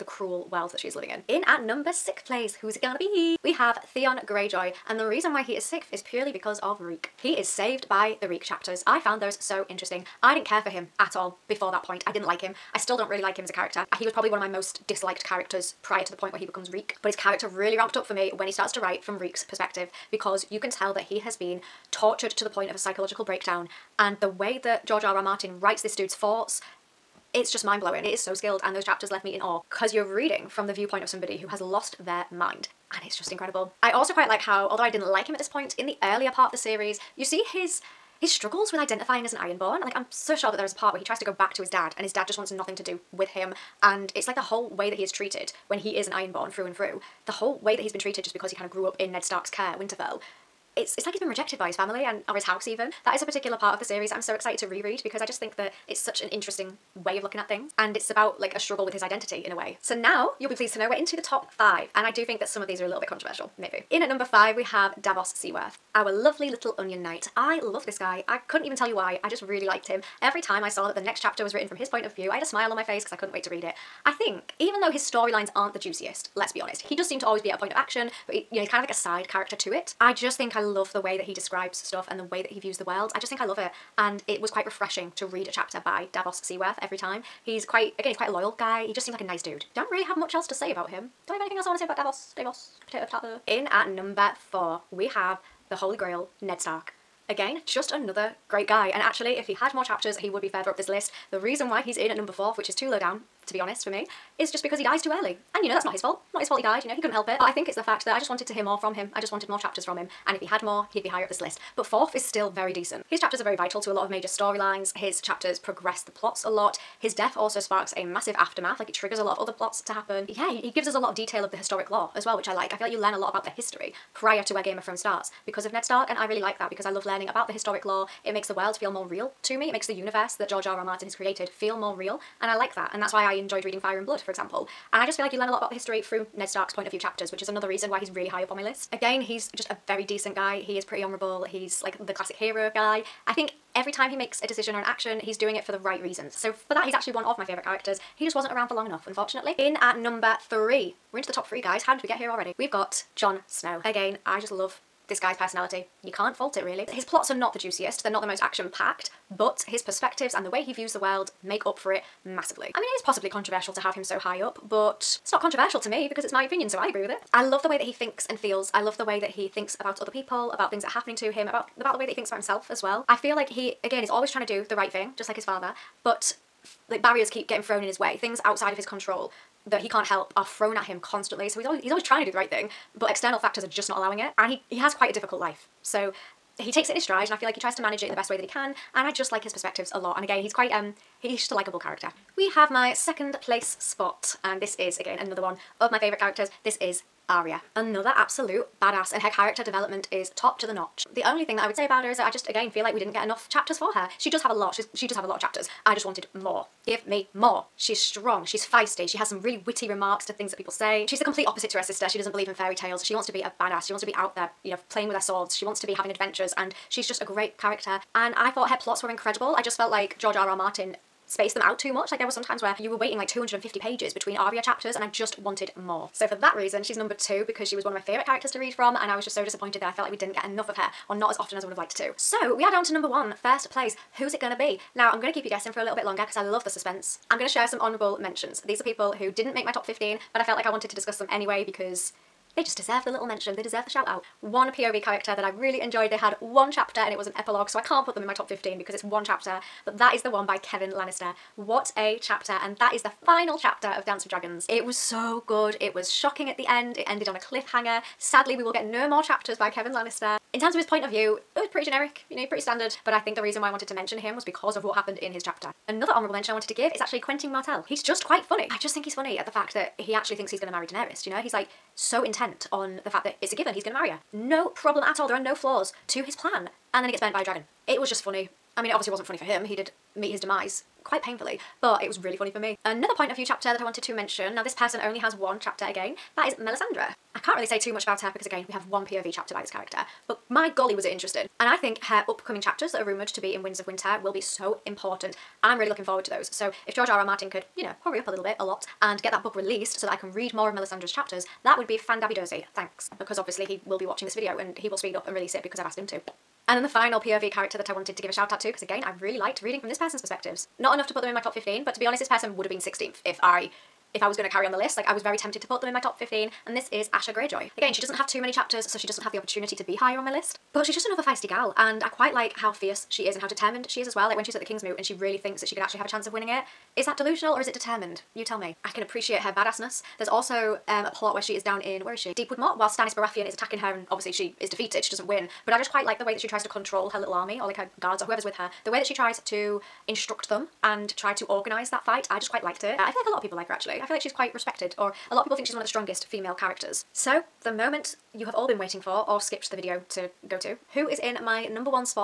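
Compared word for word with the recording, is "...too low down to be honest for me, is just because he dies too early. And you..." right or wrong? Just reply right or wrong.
right.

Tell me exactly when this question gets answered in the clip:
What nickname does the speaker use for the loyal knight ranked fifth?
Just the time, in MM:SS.
01:06.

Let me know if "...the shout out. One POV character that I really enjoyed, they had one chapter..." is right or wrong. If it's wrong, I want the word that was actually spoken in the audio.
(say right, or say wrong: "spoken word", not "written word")
right.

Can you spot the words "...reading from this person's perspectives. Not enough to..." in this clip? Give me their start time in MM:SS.
05:09.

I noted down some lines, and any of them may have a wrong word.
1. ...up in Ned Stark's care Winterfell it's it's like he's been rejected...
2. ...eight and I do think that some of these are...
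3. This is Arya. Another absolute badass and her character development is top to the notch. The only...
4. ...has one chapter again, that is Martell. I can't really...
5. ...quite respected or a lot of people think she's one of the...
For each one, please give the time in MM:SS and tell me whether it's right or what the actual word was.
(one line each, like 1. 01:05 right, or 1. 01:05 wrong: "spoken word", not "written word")
1. 00:48 right
2. 01:01 wrong: "five", not "eight"
3. 03:16 right
4. 04:45 wrong: "Melisandre", not "Martell"
5. 05:44 right.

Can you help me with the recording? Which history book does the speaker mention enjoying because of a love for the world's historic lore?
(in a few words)
Fire and Blood.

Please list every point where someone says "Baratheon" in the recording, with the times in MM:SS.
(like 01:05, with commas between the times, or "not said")
05:33.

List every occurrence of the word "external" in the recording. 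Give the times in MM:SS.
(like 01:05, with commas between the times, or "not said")
03:03.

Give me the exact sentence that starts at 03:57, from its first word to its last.
I'm going to share some honourable mentions.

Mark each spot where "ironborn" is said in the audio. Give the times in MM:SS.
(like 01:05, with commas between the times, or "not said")
00:39, 00:46.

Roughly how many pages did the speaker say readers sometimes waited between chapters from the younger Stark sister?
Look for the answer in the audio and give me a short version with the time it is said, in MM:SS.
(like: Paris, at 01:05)
250, at 03:43.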